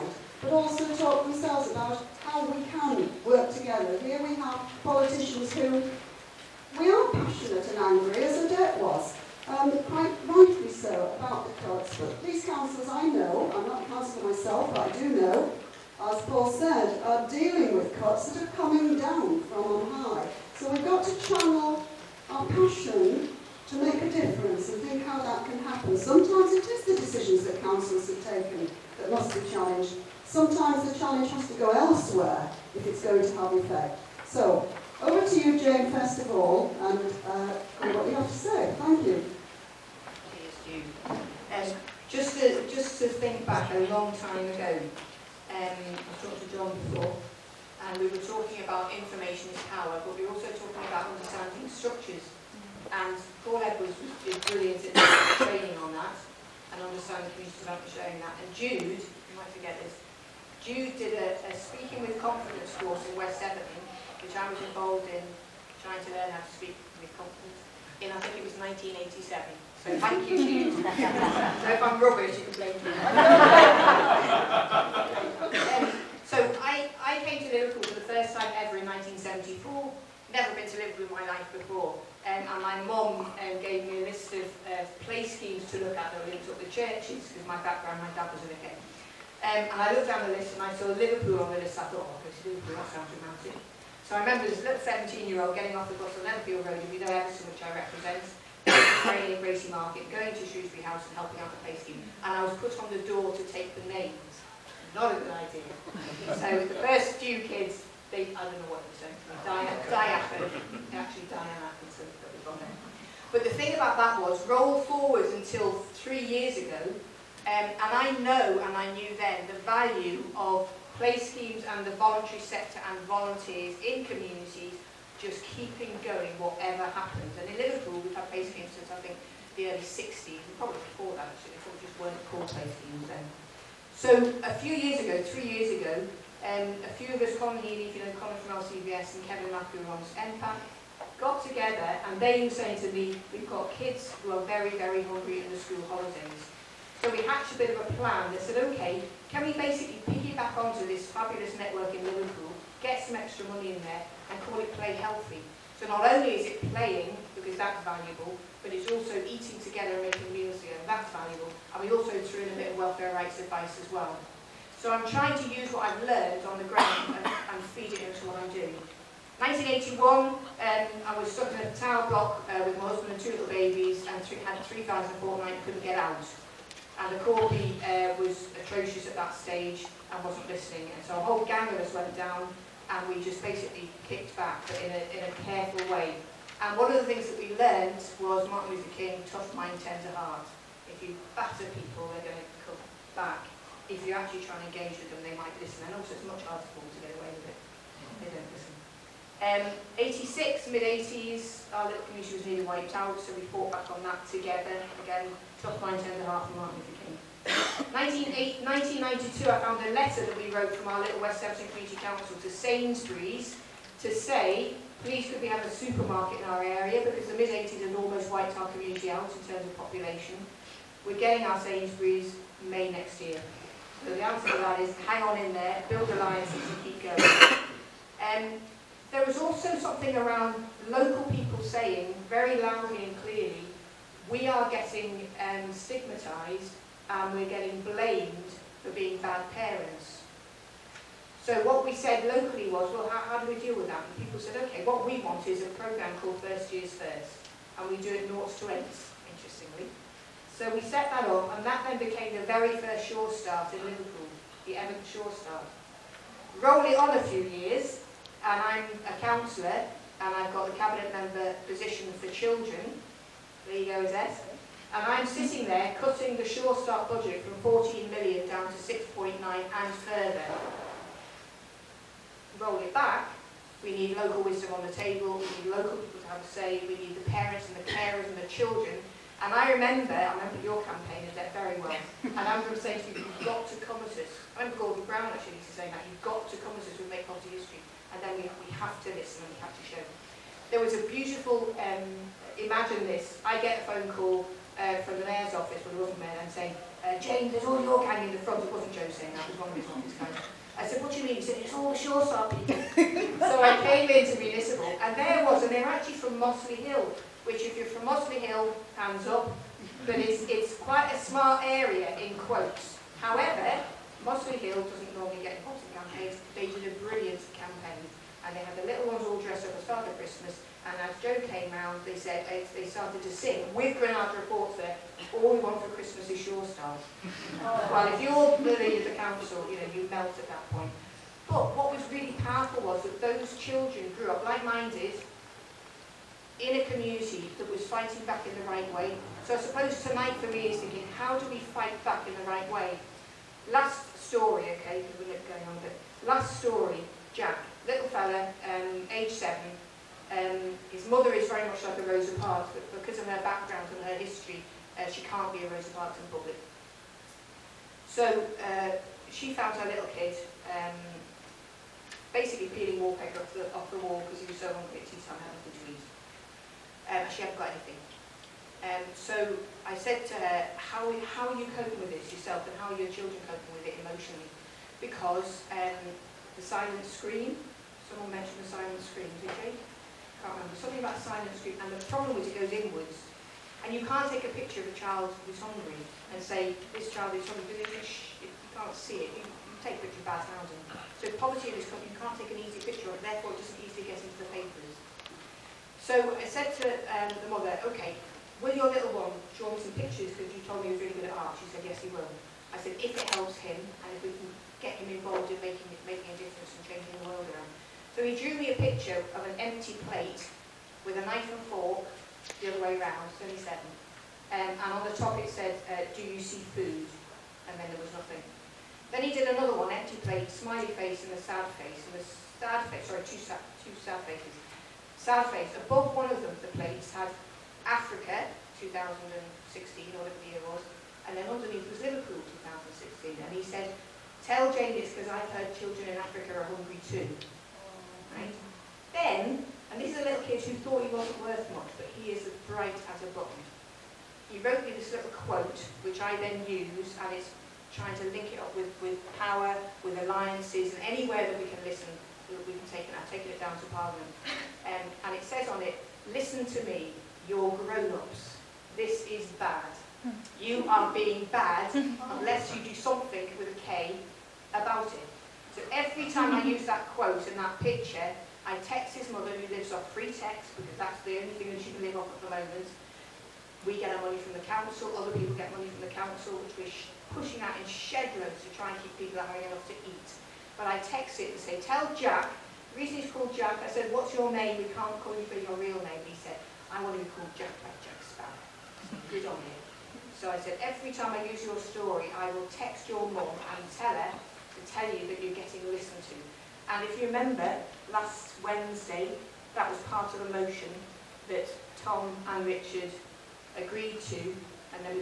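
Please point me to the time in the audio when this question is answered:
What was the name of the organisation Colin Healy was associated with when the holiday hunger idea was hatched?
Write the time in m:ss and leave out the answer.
2:18.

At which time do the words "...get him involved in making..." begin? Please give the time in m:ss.
6:44.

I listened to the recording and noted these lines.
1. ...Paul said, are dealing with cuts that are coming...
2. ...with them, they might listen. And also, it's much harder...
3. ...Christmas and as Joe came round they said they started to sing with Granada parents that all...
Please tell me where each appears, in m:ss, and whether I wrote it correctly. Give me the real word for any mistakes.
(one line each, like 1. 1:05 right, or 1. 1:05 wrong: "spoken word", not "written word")
1. 0:16 right
2. 3:14 right
3. 5:20 wrong: "reports", not "parents".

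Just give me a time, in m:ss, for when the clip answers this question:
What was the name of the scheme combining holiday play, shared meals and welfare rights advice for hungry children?
2:34.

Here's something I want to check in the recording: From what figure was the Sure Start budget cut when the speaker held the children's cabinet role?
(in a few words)
14 million.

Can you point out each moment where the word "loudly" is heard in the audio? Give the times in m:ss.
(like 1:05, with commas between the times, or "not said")
3:52.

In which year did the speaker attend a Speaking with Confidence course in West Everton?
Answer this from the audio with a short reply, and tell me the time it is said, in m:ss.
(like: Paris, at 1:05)
1987, at 1:08.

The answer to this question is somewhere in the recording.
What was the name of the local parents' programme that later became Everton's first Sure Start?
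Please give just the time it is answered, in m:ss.
4:06.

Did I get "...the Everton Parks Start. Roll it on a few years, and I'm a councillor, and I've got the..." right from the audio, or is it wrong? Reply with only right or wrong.
wrong.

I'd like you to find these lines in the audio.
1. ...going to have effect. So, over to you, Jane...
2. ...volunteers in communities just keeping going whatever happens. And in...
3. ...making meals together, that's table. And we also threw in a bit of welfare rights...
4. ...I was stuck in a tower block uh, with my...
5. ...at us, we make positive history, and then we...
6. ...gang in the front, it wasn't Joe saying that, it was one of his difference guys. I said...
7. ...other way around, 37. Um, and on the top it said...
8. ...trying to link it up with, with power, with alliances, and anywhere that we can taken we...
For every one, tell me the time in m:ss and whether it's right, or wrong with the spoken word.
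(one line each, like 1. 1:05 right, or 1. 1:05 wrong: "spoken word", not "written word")
1. 0:33 right
2. 2:03 right
3. 2:40 wrong: "valuable", not "table"
4. 2:50 right
5. 4:46 right
6. 4:58 wrong: "office", not "difference"
7. 6:52 right
8. 7:27 wrong: "listen", not "taken".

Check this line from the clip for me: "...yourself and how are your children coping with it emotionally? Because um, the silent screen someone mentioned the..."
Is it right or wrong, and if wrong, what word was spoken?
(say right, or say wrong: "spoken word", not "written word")
right.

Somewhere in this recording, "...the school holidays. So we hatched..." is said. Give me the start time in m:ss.
2:25.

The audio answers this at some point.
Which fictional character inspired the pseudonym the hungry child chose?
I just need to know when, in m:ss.
8:08.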